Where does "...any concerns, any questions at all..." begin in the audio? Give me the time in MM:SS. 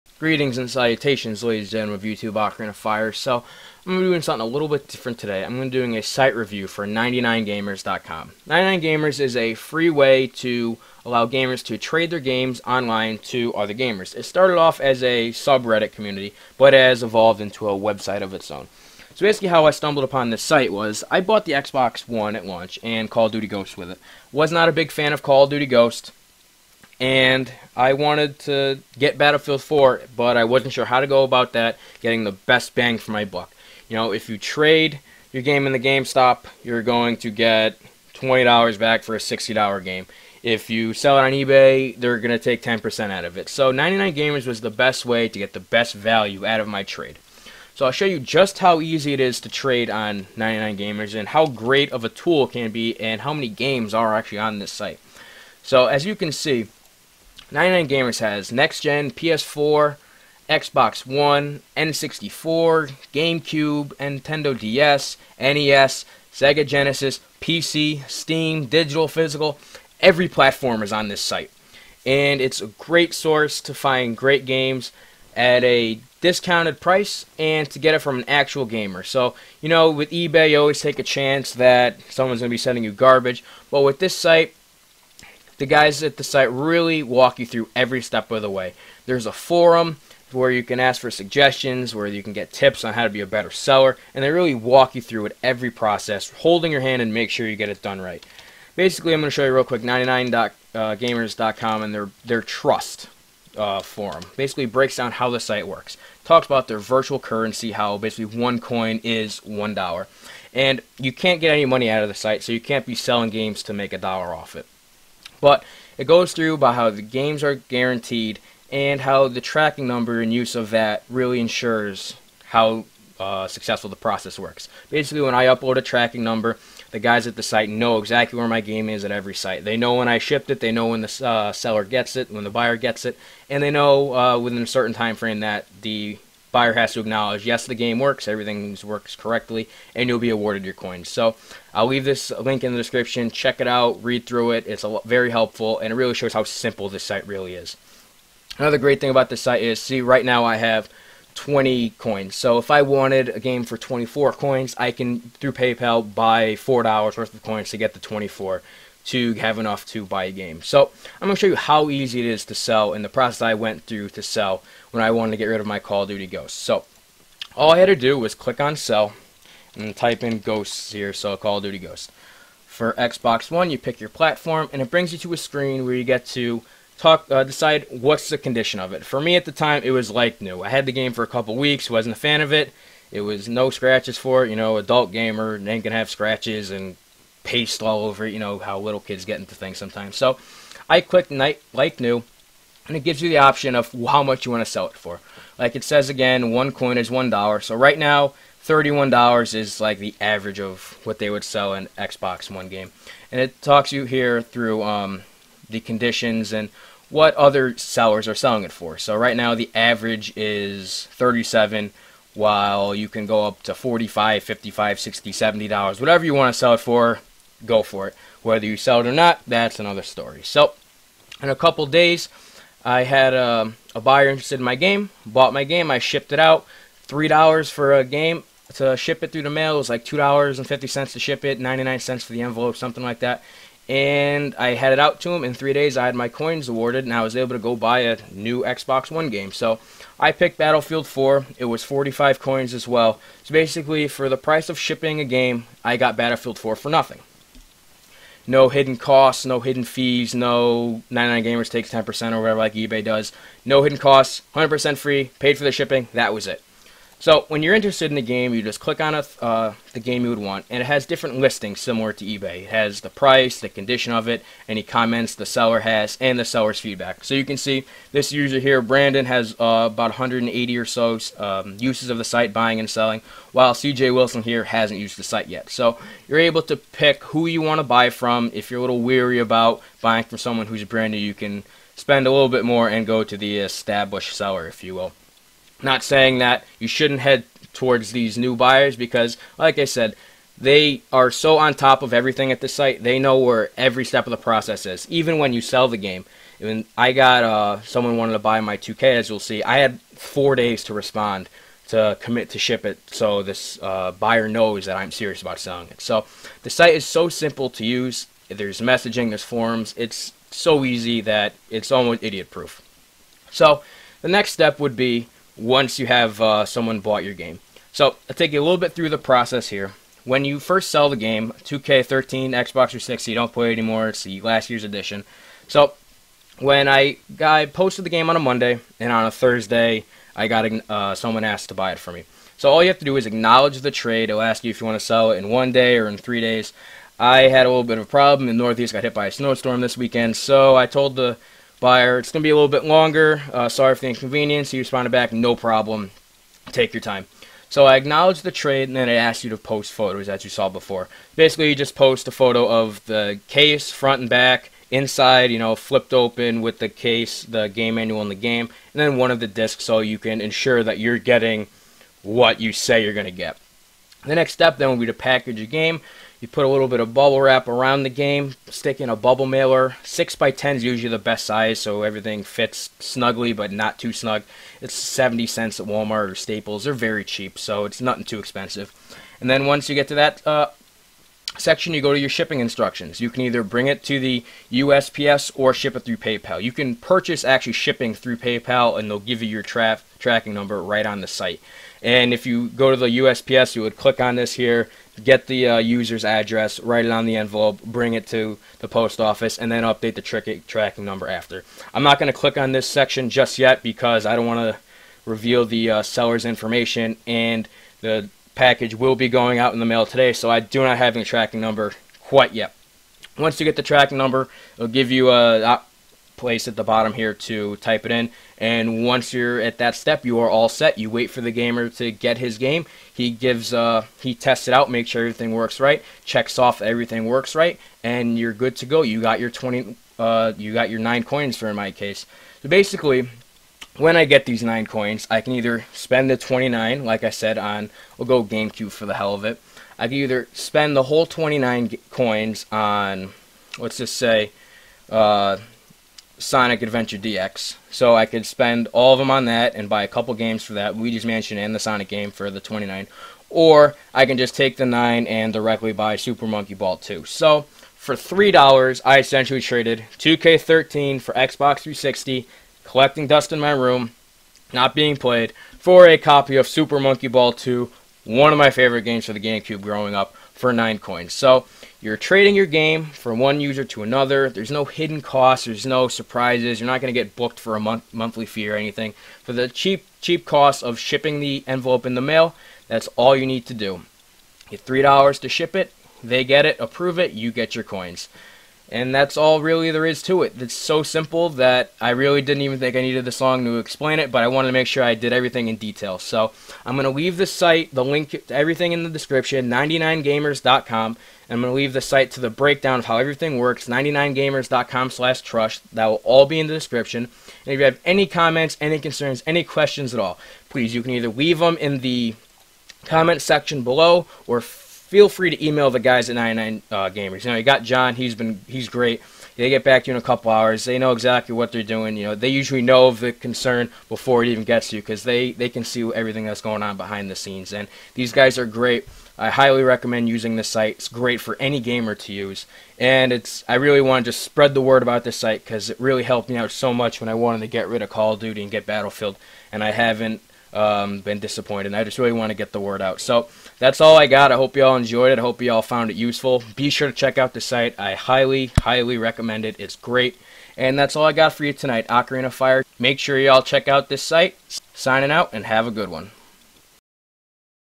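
08:28.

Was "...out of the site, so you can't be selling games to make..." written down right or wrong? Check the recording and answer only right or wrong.
right.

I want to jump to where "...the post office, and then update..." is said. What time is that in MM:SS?
06:38.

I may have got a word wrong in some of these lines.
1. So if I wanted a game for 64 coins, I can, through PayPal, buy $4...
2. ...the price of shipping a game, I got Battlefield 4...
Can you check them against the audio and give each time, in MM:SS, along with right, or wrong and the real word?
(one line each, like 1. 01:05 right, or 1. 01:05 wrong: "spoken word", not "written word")
1. 02:32 wrong: "24", not "64"
2. 04:04 right.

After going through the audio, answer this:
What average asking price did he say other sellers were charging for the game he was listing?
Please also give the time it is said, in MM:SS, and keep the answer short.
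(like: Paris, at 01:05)
37, at 03:31.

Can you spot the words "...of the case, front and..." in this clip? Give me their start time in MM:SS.
05:52.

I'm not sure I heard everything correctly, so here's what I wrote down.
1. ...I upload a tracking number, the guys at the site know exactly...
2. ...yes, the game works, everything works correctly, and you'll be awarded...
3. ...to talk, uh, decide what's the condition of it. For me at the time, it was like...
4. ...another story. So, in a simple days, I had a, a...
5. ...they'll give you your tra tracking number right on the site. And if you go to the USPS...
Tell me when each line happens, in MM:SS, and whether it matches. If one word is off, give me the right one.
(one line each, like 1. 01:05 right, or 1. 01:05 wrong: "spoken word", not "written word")
1. 02:05 right
2. 02:17 right
3. 02:56 right
4. 03:39 wrong: "couple", not "simple"
5. 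06:29 right.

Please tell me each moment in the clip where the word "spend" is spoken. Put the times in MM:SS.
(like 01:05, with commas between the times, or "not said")
04:41, 07:15, 07:20, 07:28.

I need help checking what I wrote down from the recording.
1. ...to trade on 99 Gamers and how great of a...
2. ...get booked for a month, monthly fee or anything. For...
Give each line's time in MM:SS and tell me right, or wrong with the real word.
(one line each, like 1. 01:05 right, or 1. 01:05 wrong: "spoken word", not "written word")
1. 00:49 right
2. 07:57 right.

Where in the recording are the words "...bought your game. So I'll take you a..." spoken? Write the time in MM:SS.
05:16.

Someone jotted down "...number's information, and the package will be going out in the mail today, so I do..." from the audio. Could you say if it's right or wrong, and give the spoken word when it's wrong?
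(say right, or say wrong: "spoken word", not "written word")
wrong: "seller", not "number".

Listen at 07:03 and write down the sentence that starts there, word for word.
He gives, uh, he tests it out, makes sure everything works right, checks off everything works right, and you're good to go.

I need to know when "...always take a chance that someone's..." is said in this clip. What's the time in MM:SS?
01:20.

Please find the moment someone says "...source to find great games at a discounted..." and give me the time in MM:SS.
01:13.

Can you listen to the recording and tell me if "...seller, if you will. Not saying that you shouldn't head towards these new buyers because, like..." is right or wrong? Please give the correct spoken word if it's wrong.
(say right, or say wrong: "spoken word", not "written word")
right.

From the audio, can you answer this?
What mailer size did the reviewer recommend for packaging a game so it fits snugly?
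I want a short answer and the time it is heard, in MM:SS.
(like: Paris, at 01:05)
6 by 10, at 06:10.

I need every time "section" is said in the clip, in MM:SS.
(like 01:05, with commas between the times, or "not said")
06:21, 06:42, 08:33.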